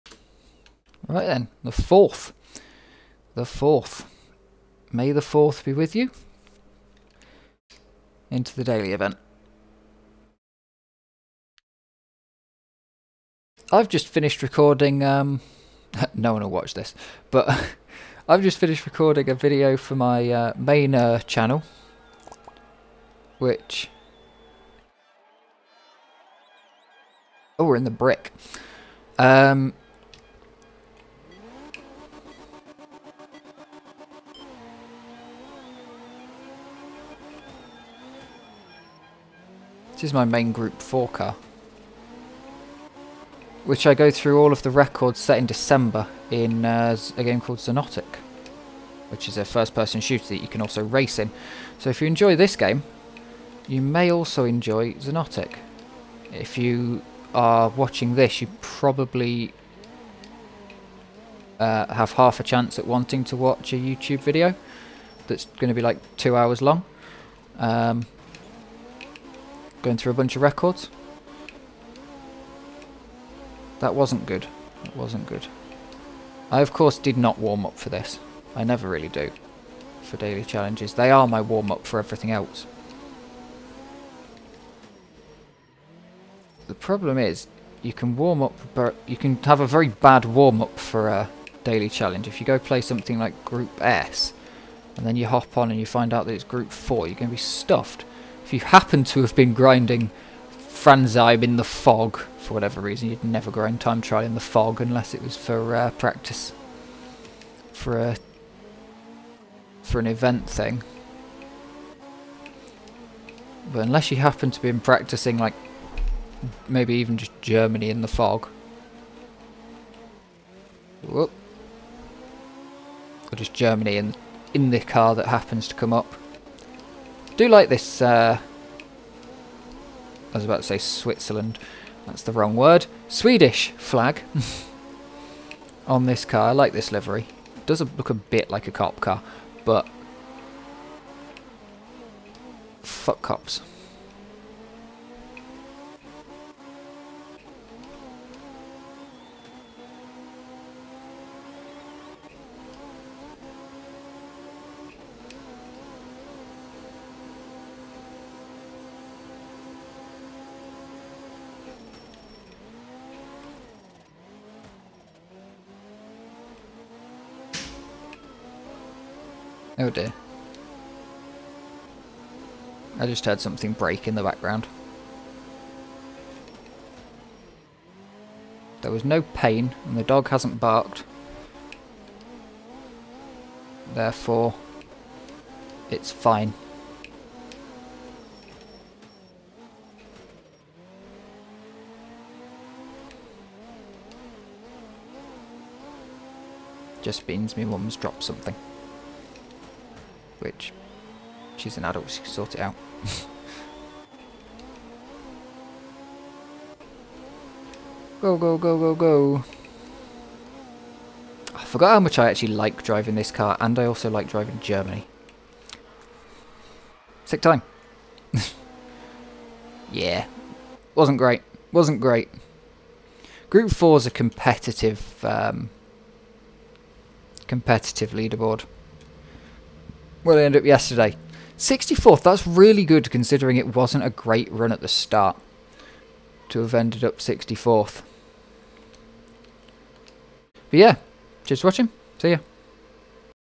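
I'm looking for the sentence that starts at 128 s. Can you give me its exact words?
Uh, I was about to say Switzerland.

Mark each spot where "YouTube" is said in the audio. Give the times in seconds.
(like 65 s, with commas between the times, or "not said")
63 s.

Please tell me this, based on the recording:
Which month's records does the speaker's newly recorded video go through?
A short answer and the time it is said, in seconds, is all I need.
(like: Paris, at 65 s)
December, at 45 s.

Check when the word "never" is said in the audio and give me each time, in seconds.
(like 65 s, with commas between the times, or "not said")
78 s, 103 s.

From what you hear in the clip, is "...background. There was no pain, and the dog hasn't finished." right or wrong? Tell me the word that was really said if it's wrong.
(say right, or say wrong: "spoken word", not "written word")
wrong: "barked", not "finished".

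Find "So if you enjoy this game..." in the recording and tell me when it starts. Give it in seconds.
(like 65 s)
51 s.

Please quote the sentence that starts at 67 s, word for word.
Um, Going through a bunch of records.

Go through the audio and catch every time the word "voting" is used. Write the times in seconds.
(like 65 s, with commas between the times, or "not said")
not said.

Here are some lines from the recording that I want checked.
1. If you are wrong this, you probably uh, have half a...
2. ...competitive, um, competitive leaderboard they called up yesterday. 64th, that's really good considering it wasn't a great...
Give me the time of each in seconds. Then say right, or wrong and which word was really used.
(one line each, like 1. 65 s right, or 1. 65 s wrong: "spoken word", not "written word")
1. 56 s wrong: "watching", not "wrong"
2. 224 s wrong: "ended", not "called".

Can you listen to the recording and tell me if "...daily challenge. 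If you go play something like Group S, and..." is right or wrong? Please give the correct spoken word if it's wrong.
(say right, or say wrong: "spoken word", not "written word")
right.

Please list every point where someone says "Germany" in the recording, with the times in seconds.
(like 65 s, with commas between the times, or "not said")
117 s, 123 s, 214 s.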